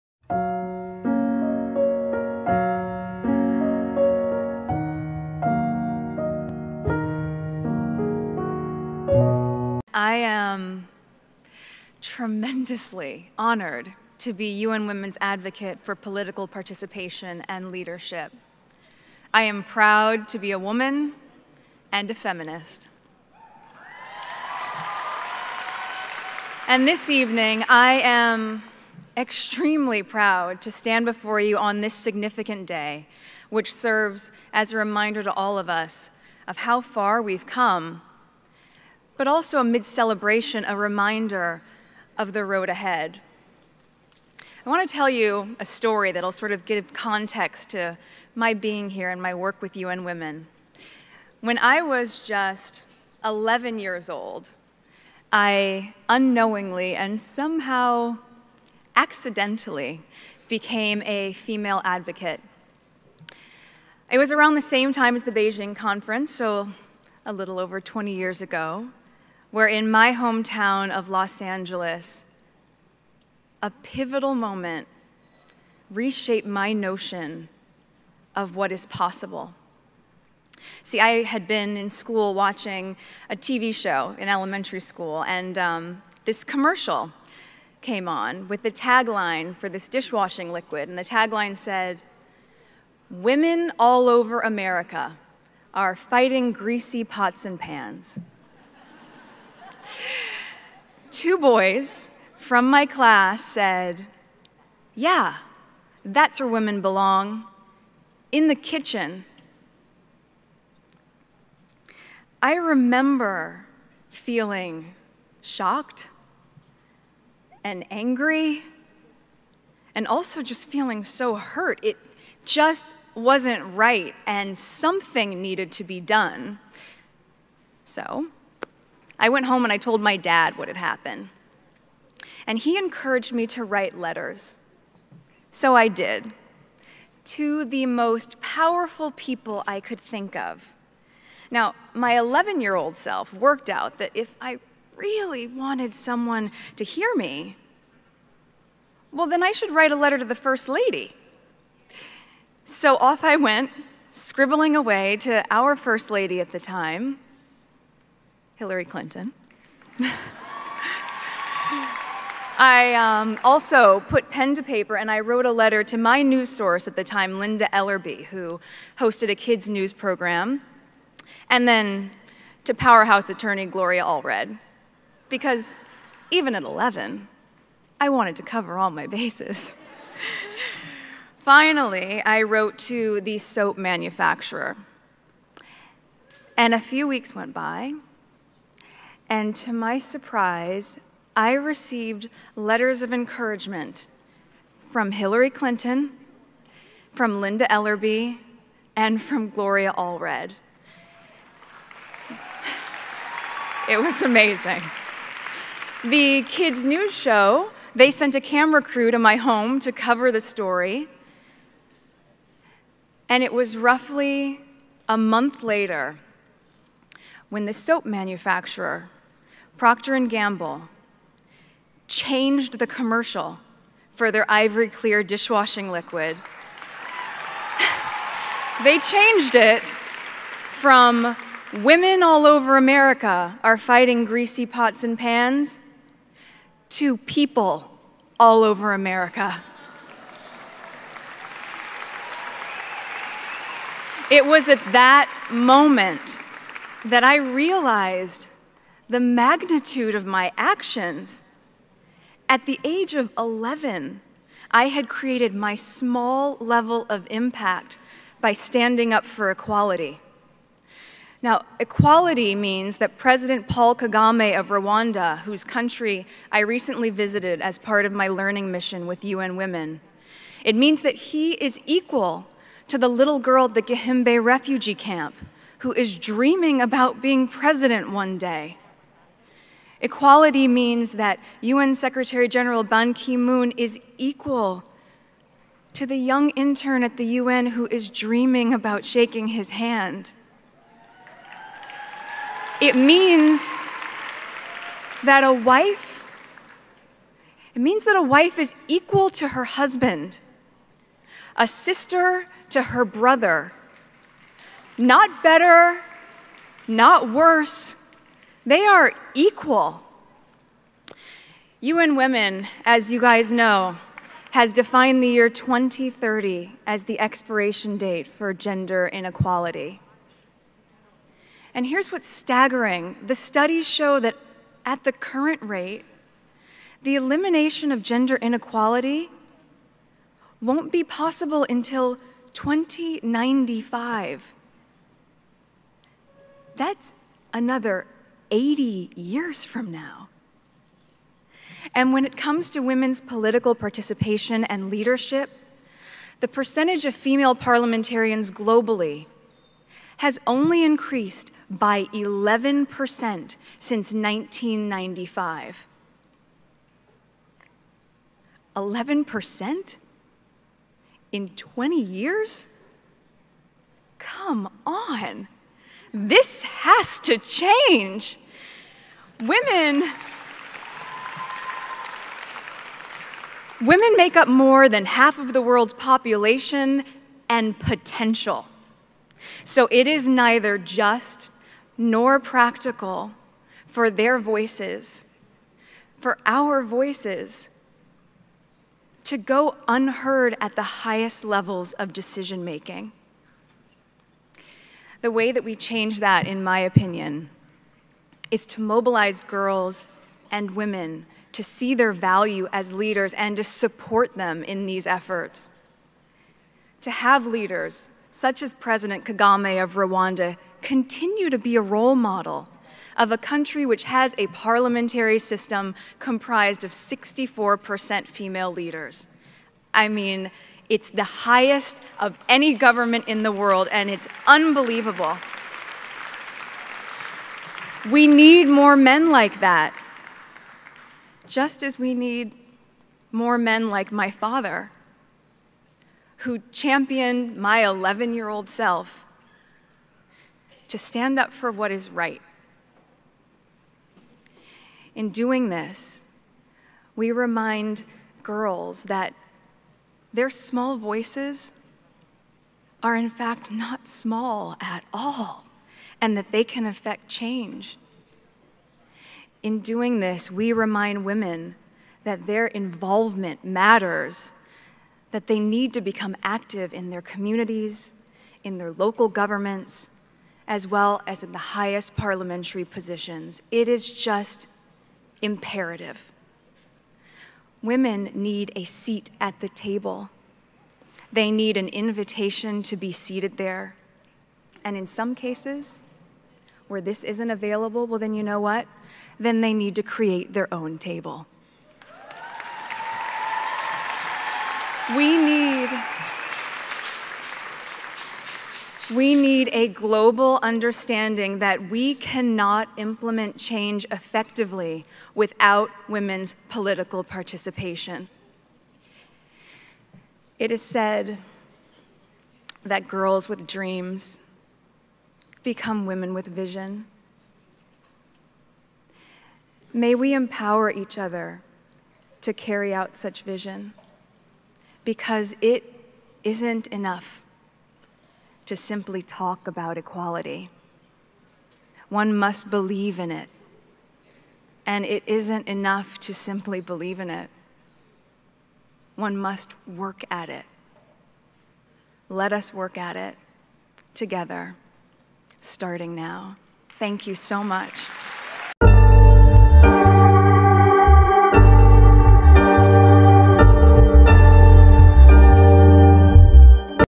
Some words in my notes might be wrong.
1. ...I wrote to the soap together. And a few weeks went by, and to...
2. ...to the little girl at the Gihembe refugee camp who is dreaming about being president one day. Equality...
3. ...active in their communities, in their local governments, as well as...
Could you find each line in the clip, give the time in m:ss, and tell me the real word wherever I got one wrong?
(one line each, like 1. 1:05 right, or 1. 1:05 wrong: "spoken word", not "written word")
1. 3:02 wrong: "manufacturer", not "together"
2. 4:32 right
3. 7:46 right.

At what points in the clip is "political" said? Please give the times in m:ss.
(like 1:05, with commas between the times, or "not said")
0:15, 5:43, 8:26.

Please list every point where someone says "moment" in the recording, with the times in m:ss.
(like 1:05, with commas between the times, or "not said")
1:14, 4:05.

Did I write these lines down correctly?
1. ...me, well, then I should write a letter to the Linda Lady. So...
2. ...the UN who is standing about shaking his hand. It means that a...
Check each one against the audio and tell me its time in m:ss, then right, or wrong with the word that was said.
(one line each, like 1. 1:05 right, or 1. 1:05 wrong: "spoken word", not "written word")
1. 2:27 wrong: "First", not "Linda"
2. 4:47 wrong: "dreaming", not "standing".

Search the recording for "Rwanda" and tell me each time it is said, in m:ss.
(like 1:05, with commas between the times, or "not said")
4:24, 6:49.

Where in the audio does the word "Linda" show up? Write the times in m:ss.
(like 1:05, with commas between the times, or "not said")
2:47, 3:17.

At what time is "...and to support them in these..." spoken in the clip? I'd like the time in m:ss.
6:43.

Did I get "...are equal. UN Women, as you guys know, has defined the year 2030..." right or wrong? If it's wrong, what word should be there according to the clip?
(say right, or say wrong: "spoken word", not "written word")
right.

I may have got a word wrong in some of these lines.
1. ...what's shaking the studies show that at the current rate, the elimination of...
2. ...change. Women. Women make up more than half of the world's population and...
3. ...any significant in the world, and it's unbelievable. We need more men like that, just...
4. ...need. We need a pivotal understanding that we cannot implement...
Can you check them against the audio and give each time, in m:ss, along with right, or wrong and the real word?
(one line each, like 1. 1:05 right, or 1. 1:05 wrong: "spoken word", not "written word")
1. 5:22 wrong: "staggering", not "shaking"
2. 6:07 right
3. 7:02 wrong: "government", not "significant"
4. 8:15 wrong: "global", not "pivotal".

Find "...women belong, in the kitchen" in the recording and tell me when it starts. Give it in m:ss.
1:46.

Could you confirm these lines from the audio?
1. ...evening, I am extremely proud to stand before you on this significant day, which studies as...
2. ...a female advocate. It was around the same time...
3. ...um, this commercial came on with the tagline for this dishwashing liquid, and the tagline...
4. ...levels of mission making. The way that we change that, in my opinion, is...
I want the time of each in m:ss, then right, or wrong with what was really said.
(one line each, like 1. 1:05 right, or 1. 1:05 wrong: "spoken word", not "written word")
1. 0:27 wrong: "serves", not "studies"
2. 1:01 right
3. 1:25 right
4. 6:31 wrong: "decision", not "mission".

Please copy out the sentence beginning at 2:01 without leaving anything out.
It just wasn't right, and something needed to be done.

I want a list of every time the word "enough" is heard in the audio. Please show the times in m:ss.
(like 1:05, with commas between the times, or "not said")
8:46, 8:55.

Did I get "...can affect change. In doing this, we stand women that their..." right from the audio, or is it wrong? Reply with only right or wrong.
wrong.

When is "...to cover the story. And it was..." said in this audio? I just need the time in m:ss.
3:29.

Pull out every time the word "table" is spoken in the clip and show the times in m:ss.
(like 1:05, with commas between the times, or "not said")
7:59, 8:10.